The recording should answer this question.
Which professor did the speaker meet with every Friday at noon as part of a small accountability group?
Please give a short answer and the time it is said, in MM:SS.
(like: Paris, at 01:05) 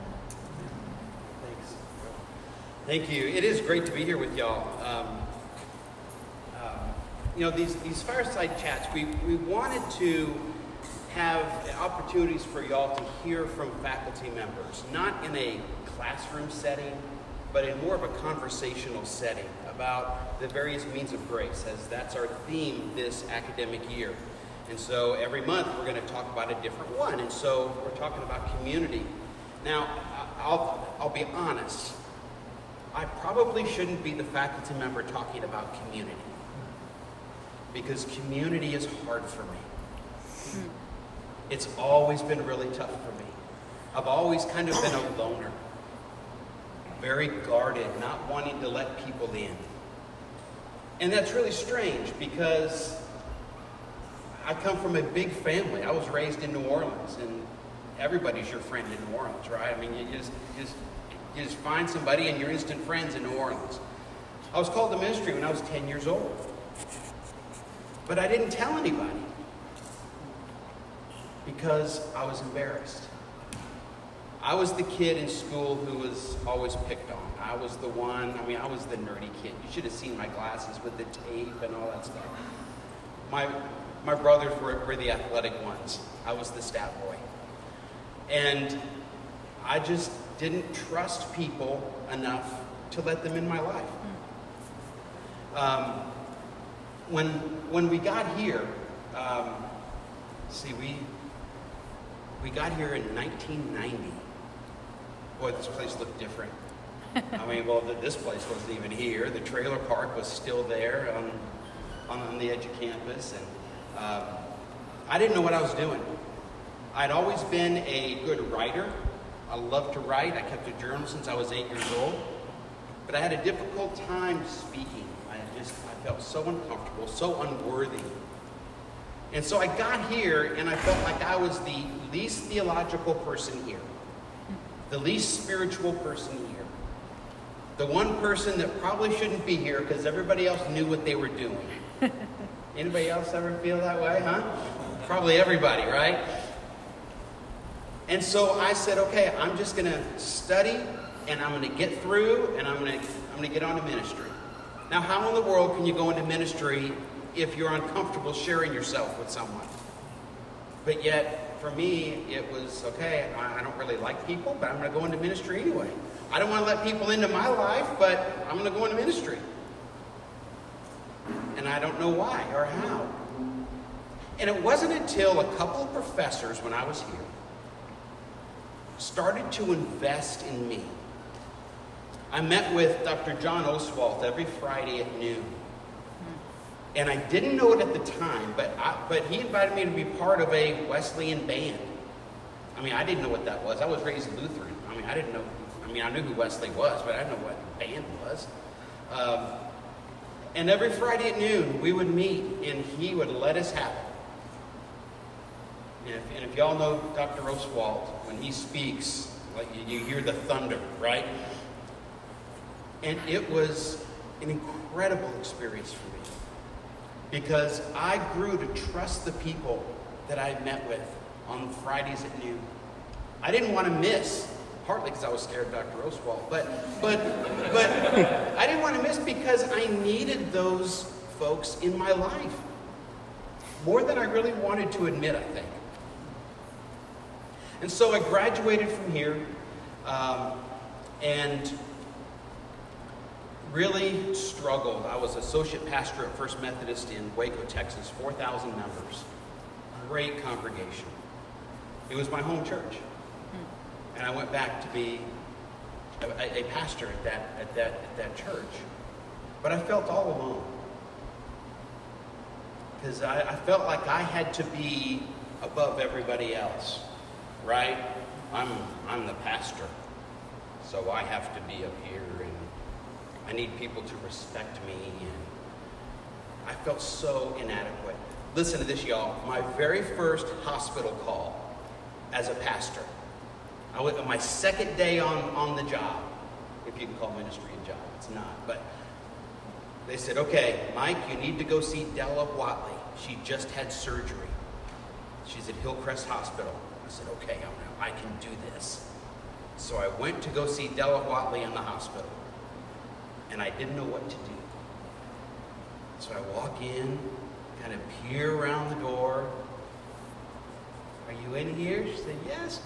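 John Oswalt, at 03:03.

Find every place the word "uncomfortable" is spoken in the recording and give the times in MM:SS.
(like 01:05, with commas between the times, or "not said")
02:06, 02:37.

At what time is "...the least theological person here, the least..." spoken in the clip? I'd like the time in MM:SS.
02:11.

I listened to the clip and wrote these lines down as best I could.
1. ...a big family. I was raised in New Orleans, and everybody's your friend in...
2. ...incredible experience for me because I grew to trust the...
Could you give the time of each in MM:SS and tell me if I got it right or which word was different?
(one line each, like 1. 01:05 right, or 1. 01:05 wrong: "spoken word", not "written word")
1. 00:54 right
2. 03:34 right.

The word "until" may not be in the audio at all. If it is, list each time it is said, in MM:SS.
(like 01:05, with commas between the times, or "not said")
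02:54.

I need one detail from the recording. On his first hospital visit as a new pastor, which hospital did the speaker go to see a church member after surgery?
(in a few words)
Hillcrest Hospital.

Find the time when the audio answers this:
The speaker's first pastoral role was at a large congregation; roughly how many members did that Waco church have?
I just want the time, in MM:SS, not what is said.
04:08.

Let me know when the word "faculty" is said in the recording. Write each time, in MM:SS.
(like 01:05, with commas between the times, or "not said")
00:13, 00:34.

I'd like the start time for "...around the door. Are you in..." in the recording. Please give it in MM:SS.
05:08.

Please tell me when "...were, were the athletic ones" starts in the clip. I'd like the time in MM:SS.
01:24.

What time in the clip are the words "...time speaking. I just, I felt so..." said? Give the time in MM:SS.
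02:04.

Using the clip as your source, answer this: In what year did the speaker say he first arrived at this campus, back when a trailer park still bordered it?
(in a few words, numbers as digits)
1990.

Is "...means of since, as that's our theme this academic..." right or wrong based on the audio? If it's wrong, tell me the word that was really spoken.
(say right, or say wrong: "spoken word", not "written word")
wrong: "grace", not "since".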